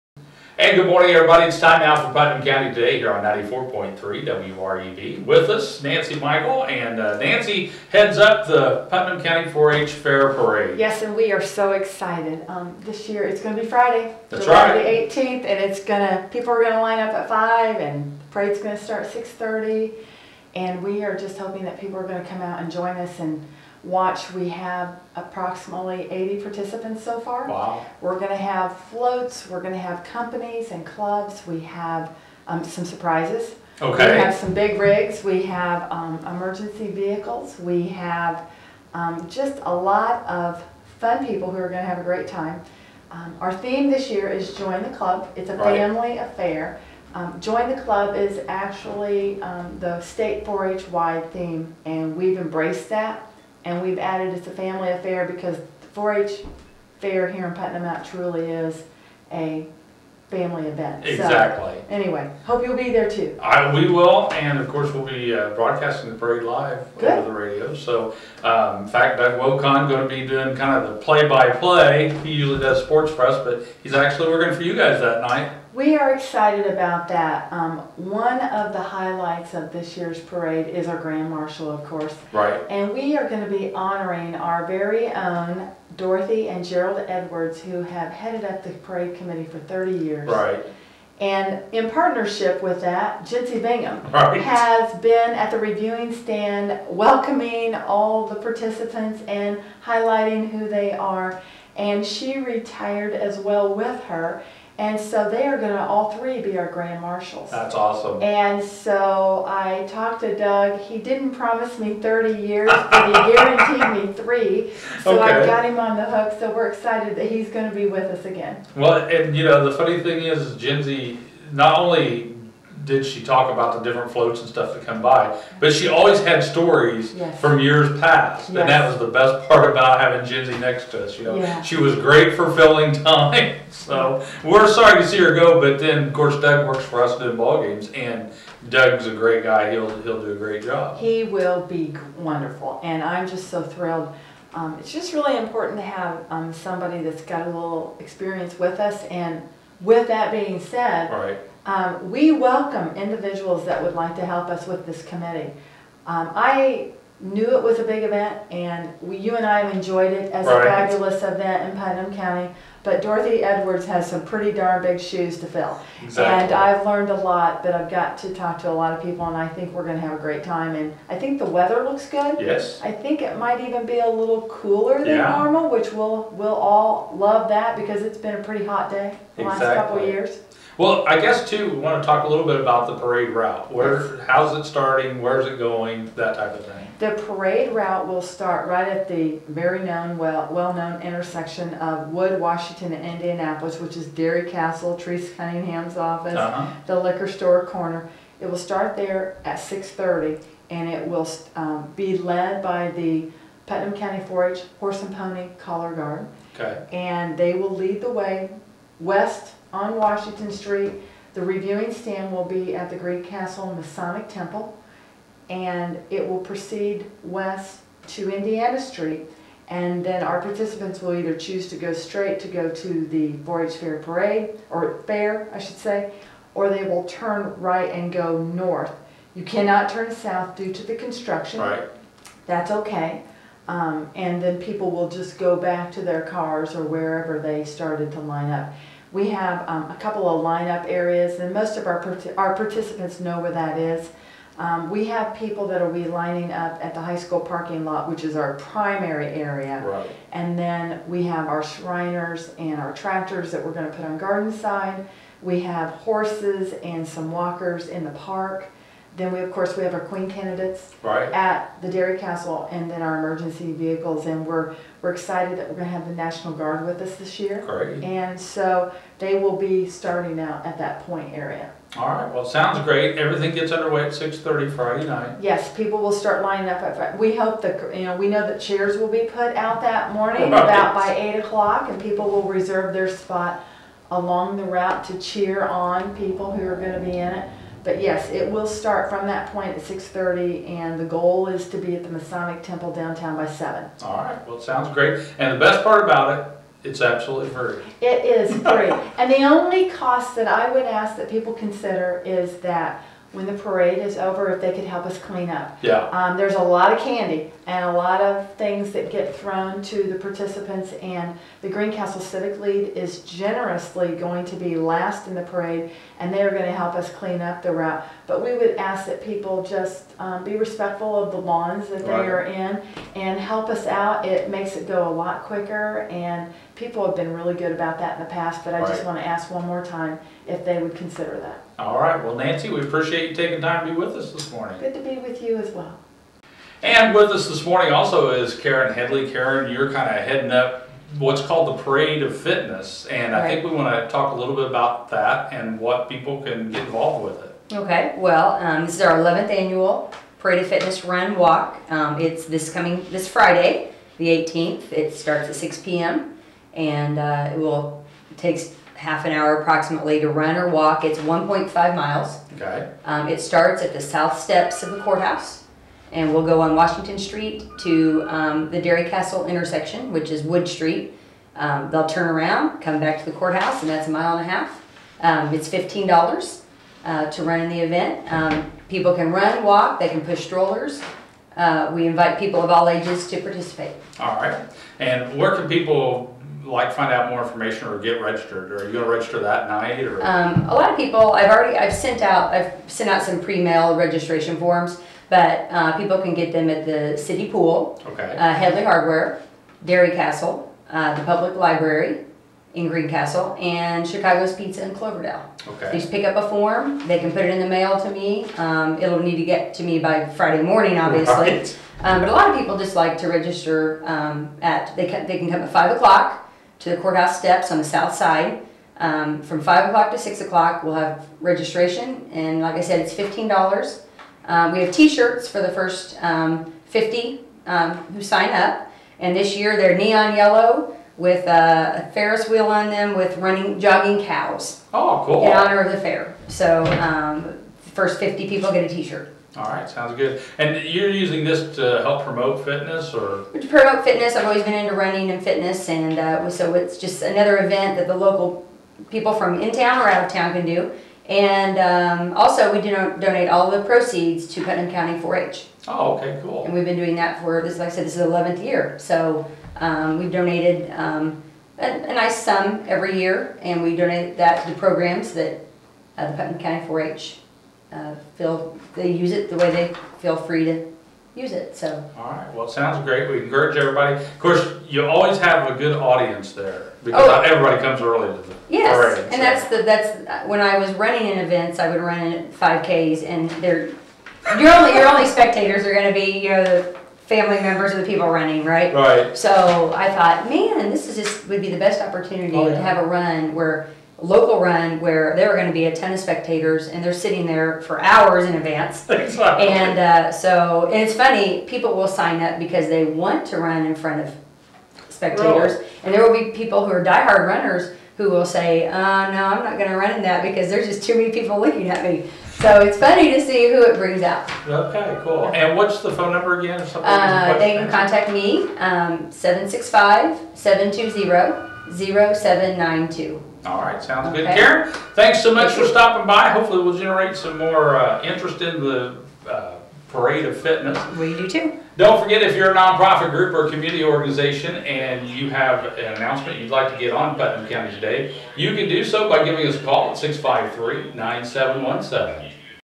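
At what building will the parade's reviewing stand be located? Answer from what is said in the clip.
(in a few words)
Greencastle Masonic Temple.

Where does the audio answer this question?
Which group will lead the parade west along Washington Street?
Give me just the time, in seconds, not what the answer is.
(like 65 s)
203 s.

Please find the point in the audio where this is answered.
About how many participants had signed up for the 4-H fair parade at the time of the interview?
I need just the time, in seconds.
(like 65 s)
25 s.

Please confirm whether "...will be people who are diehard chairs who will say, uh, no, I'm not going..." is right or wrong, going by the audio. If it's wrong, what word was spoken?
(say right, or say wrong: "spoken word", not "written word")
wrong: "runners", not "chairs".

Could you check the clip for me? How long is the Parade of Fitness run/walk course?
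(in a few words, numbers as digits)
1.5 miles.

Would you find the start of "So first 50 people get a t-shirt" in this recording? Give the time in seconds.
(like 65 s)
436 s.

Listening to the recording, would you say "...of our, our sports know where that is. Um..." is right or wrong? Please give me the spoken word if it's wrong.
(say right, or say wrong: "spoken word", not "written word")
wrong: "participants", not "sports".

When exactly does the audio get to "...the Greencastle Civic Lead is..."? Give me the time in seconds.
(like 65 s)
311 s.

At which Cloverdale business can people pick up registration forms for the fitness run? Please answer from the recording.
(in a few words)
Chicago's Pizza.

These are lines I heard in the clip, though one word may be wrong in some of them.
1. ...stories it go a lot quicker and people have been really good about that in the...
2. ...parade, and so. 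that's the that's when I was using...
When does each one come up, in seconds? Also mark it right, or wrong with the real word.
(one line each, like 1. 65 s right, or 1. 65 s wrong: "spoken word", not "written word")
1. 324 s wrong: "makes", not "stories"
2. 478 s wrong: "running", not "using".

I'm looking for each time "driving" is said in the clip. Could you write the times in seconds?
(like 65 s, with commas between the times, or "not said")
not said.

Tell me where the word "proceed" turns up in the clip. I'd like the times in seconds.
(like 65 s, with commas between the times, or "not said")
216 s, 453 s.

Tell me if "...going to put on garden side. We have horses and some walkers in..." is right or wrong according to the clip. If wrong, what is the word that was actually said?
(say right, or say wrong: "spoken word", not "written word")
right.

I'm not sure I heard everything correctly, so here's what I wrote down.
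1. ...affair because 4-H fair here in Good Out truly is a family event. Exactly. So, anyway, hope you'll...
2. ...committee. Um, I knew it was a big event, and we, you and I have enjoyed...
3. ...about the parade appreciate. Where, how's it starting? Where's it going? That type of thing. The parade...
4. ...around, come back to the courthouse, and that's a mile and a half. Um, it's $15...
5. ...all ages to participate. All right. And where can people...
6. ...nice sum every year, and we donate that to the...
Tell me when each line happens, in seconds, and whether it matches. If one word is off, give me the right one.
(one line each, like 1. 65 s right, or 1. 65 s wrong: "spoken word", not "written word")
1. 54 s wrong: "Putnam", not "Good"
2. 155 s right
3. 182 s wrong: "route", not "appreciate"
4. 372 s right
5. 382 s right
6. 462 s right.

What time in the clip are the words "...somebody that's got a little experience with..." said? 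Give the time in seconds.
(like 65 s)
146 s.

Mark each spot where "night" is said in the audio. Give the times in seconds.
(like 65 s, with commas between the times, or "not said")
75 s, 275 s, 389 s.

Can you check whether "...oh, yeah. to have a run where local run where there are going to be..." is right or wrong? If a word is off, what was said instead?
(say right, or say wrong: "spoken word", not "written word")
right.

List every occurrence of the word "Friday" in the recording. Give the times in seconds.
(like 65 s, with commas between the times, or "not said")
13 s, 274 s, 353 s, 410 s.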